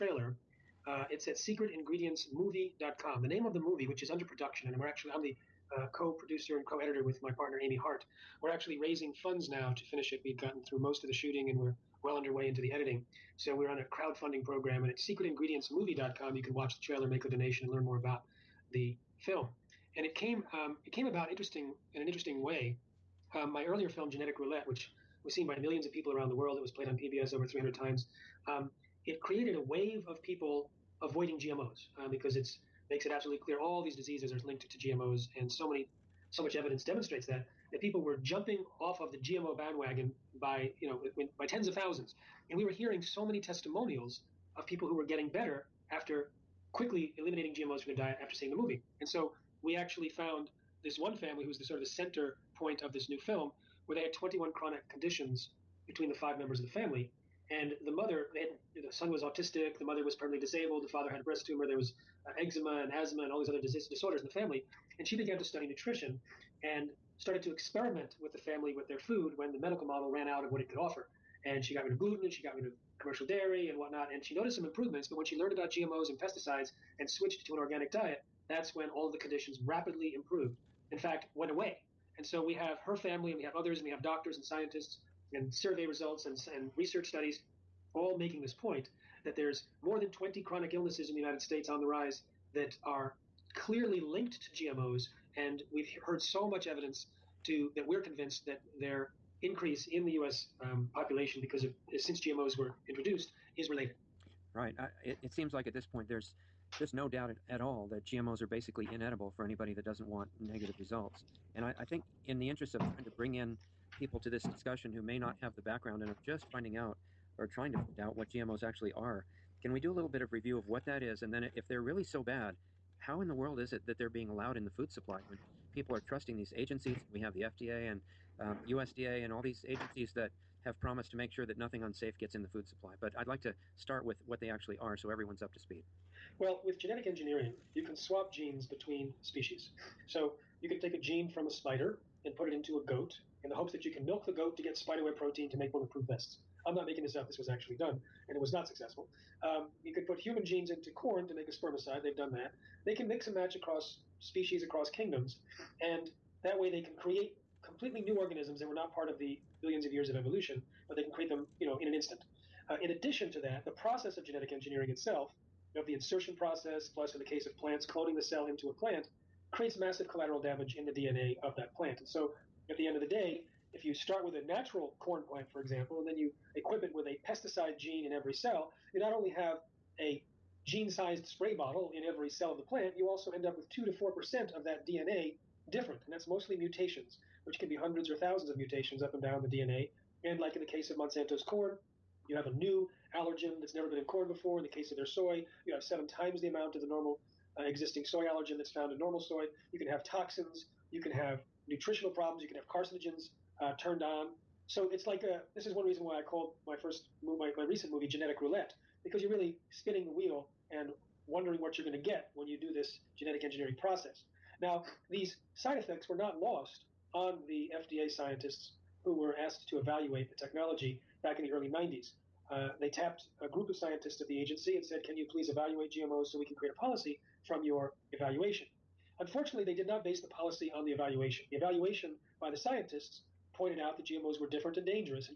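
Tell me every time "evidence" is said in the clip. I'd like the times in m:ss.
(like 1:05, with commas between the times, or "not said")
0:36, 1:36.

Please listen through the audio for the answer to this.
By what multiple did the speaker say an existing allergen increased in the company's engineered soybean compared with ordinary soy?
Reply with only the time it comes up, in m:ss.
3:15.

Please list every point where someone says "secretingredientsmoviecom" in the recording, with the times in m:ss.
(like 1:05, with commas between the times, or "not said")
0:01, 0:14.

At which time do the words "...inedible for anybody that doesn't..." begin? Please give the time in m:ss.
1:48.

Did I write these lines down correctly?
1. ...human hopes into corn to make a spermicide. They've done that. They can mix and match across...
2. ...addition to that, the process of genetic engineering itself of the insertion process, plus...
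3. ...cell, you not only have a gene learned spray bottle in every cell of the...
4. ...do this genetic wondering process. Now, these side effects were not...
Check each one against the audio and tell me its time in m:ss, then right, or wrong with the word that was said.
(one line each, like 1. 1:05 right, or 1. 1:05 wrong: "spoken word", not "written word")
1. 2:30 wrong: "genes", not "hopes"
2. 2:42 right
3. 2:58 wrong: "sized", not "learned"
4. 3:32 wrong: "engineering", not "wondering".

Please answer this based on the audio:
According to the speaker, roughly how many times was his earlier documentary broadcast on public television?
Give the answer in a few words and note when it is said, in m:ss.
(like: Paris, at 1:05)
over 300, at 0:27.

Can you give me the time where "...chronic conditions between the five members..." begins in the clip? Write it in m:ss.
0:54.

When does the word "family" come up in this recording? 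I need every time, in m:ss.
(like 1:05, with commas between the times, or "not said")
0:51, 0:56, 1:04, 1:08, 1:22.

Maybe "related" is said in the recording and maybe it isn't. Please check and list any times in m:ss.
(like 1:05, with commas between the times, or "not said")
1:43.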